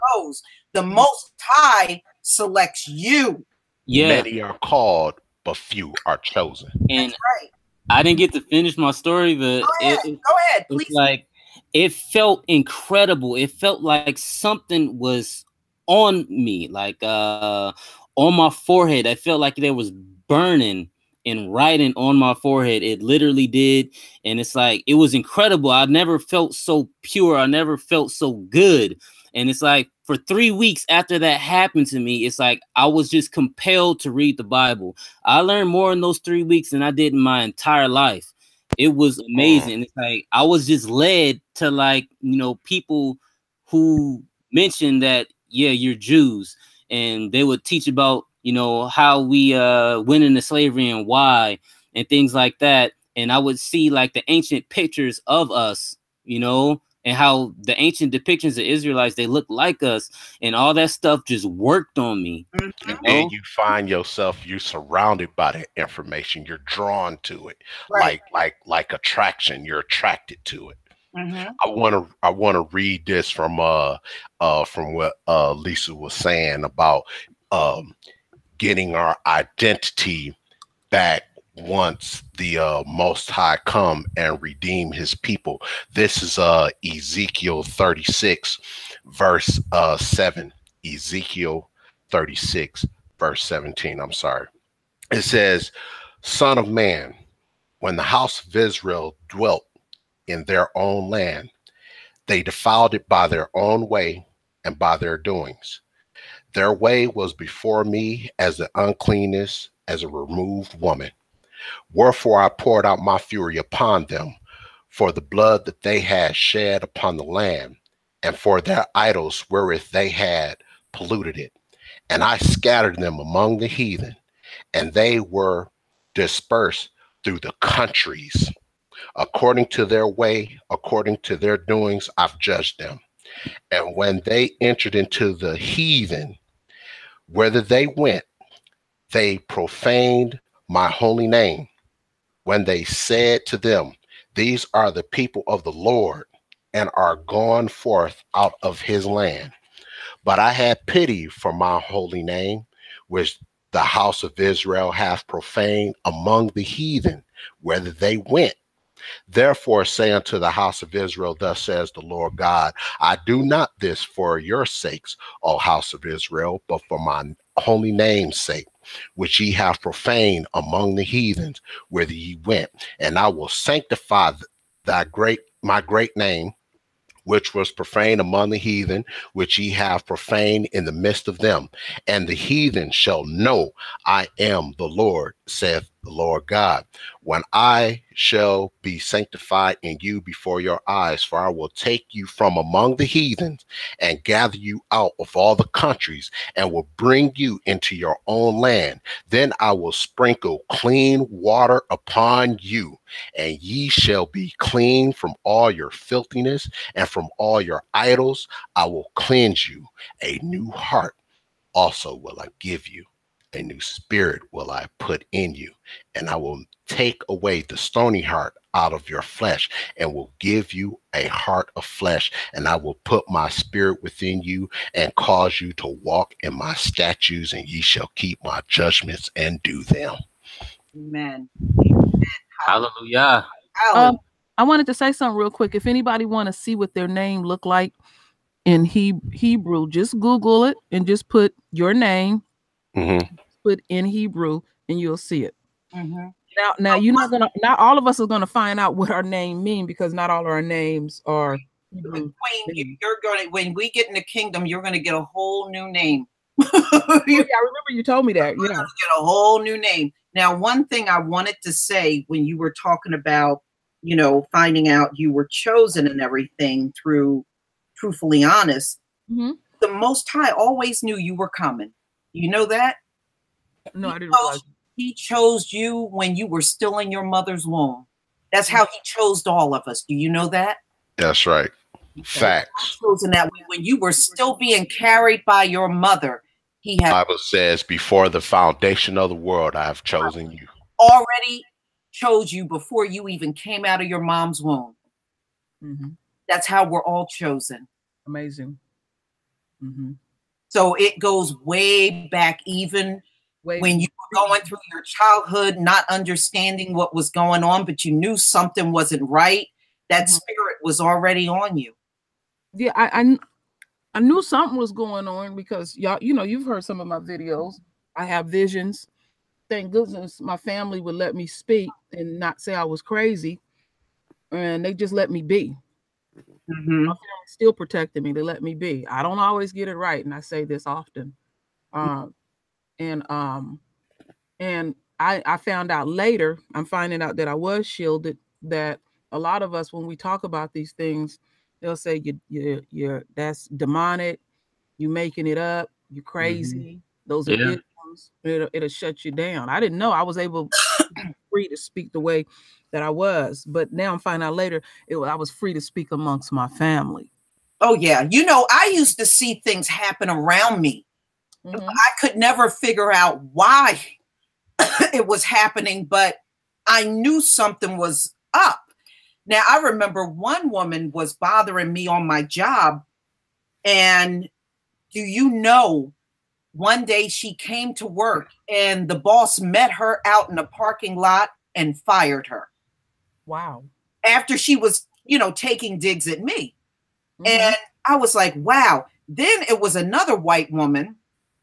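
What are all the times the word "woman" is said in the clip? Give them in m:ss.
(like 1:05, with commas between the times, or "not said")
1:50, 6:10, 6:30.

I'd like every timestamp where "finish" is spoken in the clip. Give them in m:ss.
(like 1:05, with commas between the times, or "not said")
0:08.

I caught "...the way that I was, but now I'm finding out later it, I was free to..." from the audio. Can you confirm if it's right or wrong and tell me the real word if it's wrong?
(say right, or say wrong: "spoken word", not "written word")
right.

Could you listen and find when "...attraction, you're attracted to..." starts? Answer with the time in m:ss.
1:08.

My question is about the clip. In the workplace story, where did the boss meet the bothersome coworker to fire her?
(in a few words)
parking lot.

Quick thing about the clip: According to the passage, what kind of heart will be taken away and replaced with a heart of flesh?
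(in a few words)
stony heart.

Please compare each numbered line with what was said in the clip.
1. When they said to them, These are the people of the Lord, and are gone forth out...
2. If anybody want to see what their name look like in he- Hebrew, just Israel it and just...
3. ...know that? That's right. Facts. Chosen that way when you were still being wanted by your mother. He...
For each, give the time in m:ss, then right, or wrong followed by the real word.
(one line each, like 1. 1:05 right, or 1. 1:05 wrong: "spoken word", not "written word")
1. 2:22 right
2. 3:55 wrong: "Google", not "Israel"
3. 4:40 wrong: "carried", not "wanted".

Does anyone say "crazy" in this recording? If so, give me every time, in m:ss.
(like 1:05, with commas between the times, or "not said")
5:23, 5:46.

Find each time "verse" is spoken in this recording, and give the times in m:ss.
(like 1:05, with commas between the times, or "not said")
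1:29, 1:33.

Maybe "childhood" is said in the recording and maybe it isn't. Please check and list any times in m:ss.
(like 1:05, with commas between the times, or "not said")
5:05.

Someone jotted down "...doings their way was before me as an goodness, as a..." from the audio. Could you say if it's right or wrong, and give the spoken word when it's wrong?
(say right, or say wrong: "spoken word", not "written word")
wrong: "uncleanness", not "goodness".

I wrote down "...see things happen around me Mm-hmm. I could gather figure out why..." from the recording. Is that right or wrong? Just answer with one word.
wrong.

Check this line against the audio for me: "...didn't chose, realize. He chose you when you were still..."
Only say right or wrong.
right.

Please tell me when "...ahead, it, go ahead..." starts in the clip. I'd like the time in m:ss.
0:09.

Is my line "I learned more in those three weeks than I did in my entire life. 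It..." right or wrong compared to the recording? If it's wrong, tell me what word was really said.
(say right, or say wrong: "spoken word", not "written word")
right.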